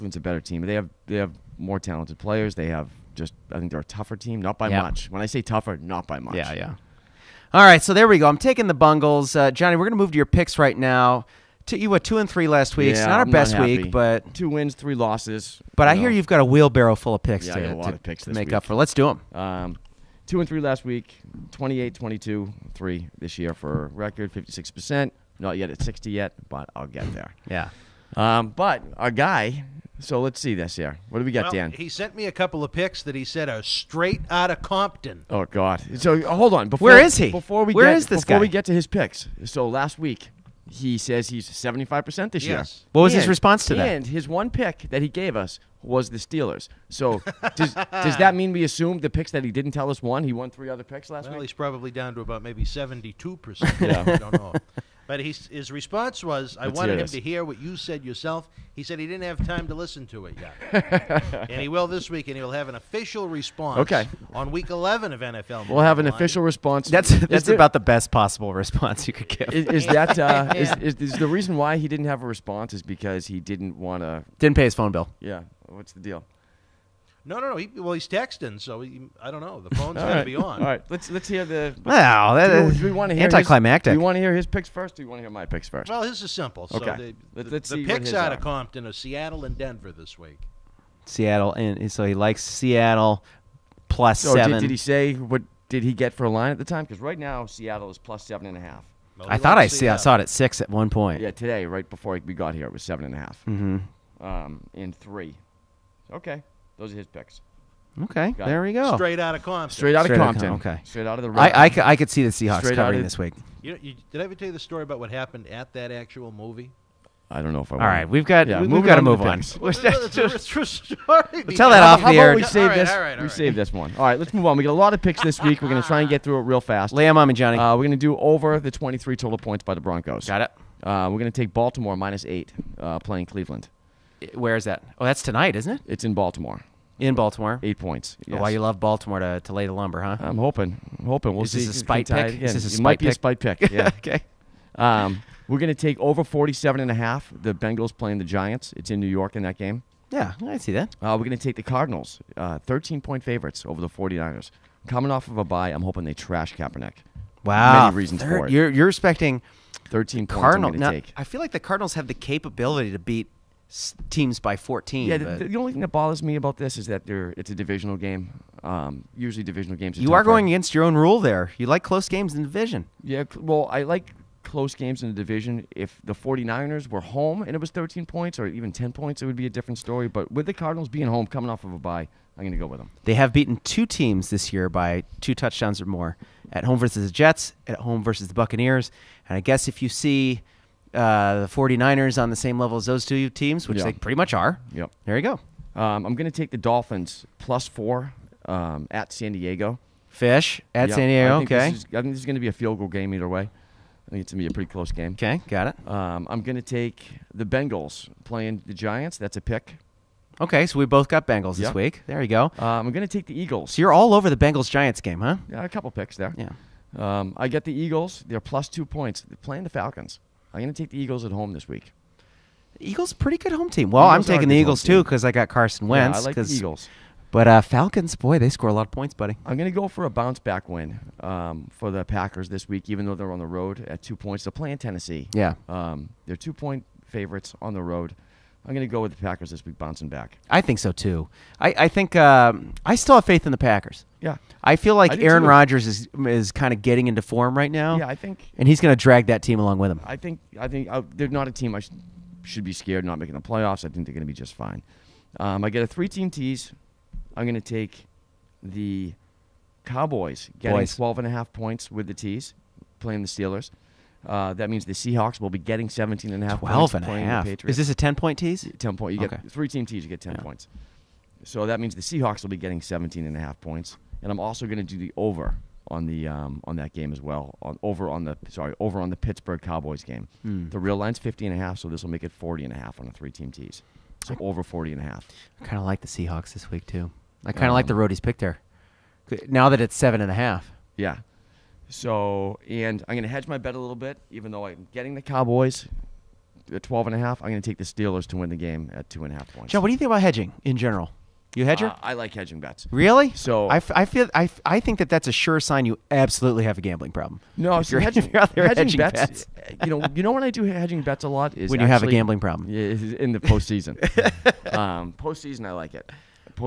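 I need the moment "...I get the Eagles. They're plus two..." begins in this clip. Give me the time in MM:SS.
03:37.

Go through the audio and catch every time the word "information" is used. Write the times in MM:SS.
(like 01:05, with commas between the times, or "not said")
not said.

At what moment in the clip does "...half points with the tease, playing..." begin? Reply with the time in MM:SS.
04:21.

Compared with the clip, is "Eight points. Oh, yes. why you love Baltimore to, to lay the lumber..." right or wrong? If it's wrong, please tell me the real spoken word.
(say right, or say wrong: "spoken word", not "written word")
right.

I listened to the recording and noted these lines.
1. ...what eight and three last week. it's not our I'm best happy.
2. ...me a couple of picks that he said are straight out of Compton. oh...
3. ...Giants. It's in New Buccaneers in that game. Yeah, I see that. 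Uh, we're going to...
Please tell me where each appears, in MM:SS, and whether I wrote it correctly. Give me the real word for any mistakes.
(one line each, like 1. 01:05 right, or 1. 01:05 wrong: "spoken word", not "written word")
1. 00:11 wrong: "two", not "eight"
2. 00:32 right
3. 02:28 wrong: "York", not "Buccaneers".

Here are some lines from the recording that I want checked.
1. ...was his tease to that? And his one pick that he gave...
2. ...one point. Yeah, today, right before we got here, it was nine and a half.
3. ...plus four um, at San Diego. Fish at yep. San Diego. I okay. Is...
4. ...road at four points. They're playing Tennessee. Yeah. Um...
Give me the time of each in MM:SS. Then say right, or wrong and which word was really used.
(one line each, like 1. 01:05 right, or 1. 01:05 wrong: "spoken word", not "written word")
1. 00:43 wrong: "response", not "tease"
2. 01:40 wrong: "seven", not "nine"
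3. 03:17 right
4. 03:53 wrong: "two", not "four".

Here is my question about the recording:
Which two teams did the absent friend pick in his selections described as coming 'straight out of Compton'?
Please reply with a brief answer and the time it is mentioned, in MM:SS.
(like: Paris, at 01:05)
Seattle and Denver, at 01:28.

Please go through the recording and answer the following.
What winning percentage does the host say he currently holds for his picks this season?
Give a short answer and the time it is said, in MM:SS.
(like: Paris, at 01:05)
56%, at 00:24.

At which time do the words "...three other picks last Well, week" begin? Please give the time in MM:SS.
00:50.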